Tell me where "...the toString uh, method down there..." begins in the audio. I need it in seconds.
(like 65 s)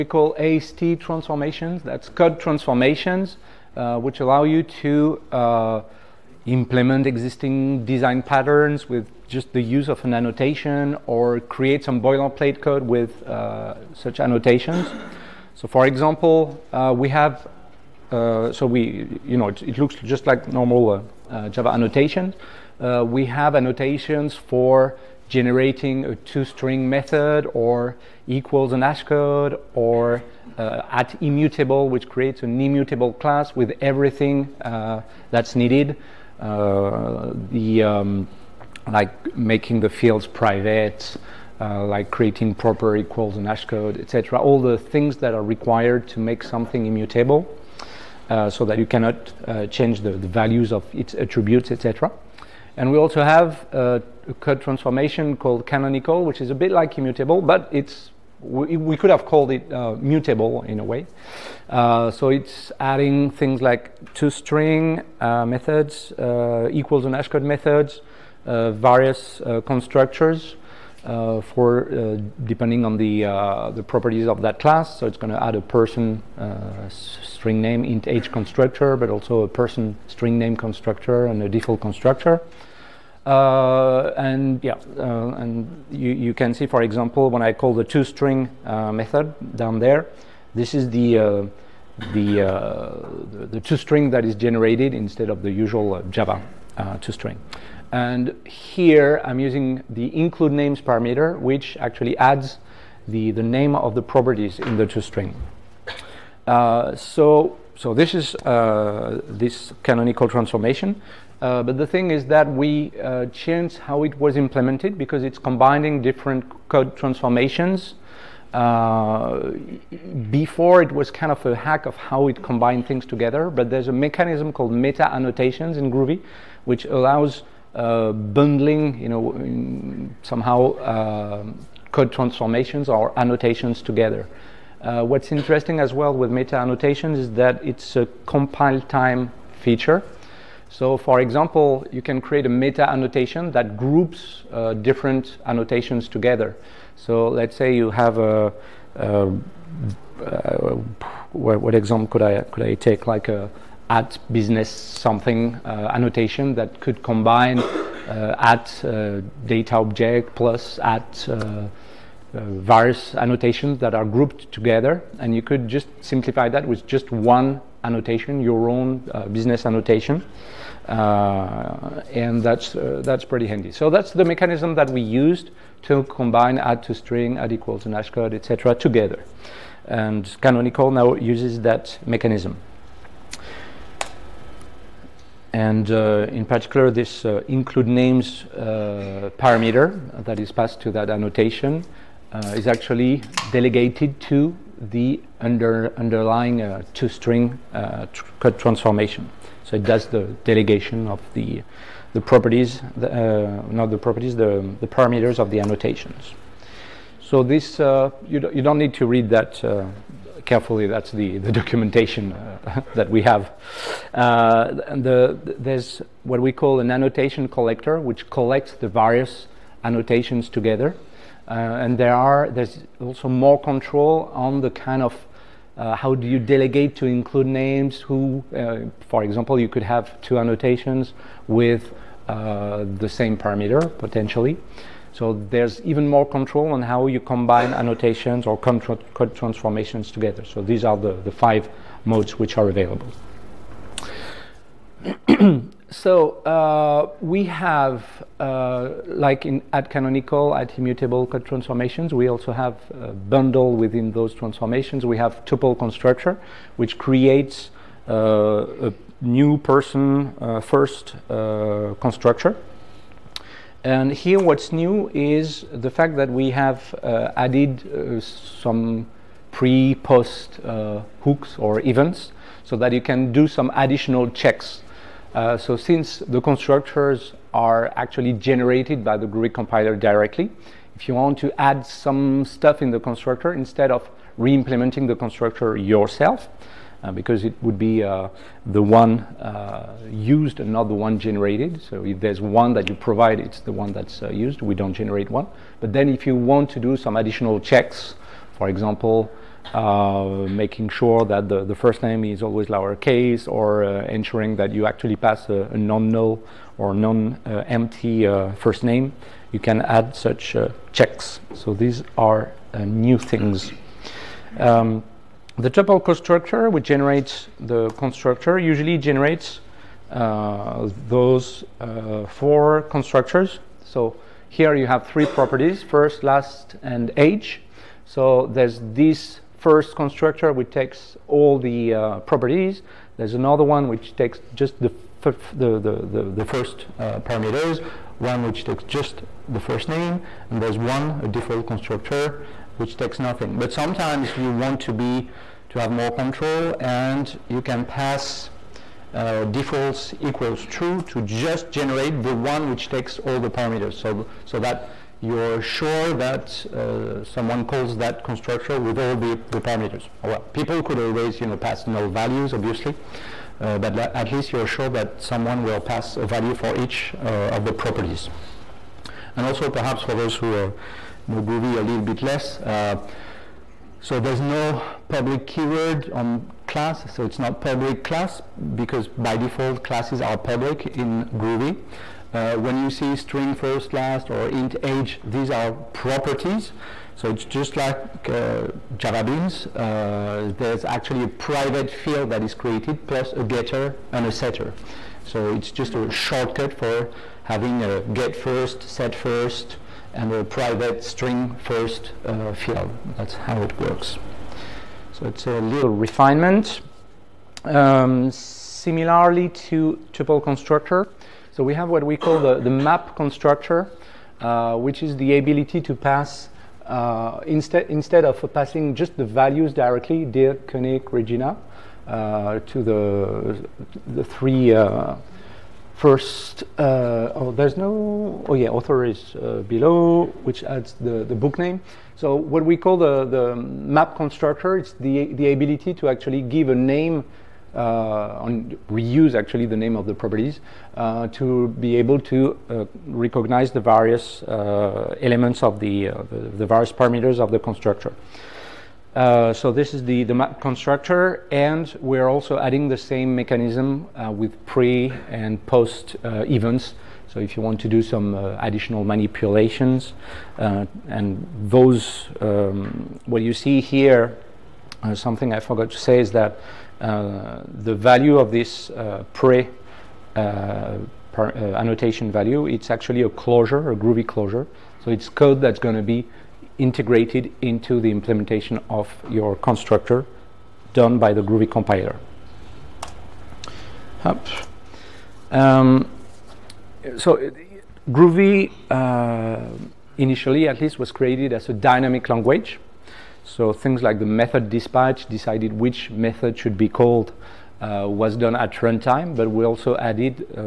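87 s.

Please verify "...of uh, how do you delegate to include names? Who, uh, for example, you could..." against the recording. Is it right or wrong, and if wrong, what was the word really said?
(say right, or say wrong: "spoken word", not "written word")
right.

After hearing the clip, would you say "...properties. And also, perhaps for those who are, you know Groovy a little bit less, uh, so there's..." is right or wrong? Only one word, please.
right.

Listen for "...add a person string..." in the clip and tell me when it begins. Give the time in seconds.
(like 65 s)
75 s.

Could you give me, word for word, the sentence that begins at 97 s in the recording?
And here I'm using the include names parameter, which actually adds the the name of the properties in the toString.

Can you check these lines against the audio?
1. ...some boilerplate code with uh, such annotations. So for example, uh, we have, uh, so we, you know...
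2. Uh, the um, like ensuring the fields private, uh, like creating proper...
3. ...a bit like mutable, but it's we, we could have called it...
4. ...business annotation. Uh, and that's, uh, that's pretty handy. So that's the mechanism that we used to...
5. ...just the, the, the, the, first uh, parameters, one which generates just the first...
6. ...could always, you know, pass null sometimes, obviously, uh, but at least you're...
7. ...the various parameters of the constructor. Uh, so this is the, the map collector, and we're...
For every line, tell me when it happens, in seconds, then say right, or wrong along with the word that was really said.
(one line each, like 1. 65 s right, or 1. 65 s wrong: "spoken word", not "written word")
1. 11 s right
2. 36 s wrong: "making", not "ensuring"
3. 56 s wrong: "immutable", not "mutable"
4. 169 s right
5. 334 s wrong: "takes", not "generates"
6. 360 s wrong: "values", not "sometimes"
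7. 446 s wrong: "constructor", not "collector".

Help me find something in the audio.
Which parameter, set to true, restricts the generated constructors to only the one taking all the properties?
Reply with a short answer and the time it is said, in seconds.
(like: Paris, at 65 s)
defaults, at 349 s.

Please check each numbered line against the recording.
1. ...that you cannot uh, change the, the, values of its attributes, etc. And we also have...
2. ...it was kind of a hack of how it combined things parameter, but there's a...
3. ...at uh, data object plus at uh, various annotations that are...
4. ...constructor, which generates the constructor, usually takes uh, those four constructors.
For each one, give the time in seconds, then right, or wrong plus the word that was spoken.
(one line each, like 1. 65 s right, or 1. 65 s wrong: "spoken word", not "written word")
1. 48 s right
2. 120 s wrong: "together", not "parameter"
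3. 158 s right
4. 316 s wrong: "generates", not "takes".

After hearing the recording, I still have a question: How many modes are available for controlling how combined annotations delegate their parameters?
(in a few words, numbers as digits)
5.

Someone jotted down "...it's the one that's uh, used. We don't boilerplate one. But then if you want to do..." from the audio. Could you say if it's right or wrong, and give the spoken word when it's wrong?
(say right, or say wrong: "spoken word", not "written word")
wrong: "generate", not "boilerplate".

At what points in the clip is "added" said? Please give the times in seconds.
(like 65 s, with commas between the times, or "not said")
267 s, 499 s.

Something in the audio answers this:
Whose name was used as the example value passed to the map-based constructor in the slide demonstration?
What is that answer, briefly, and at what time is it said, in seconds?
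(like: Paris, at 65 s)
Dierk Koenig, at 420 s.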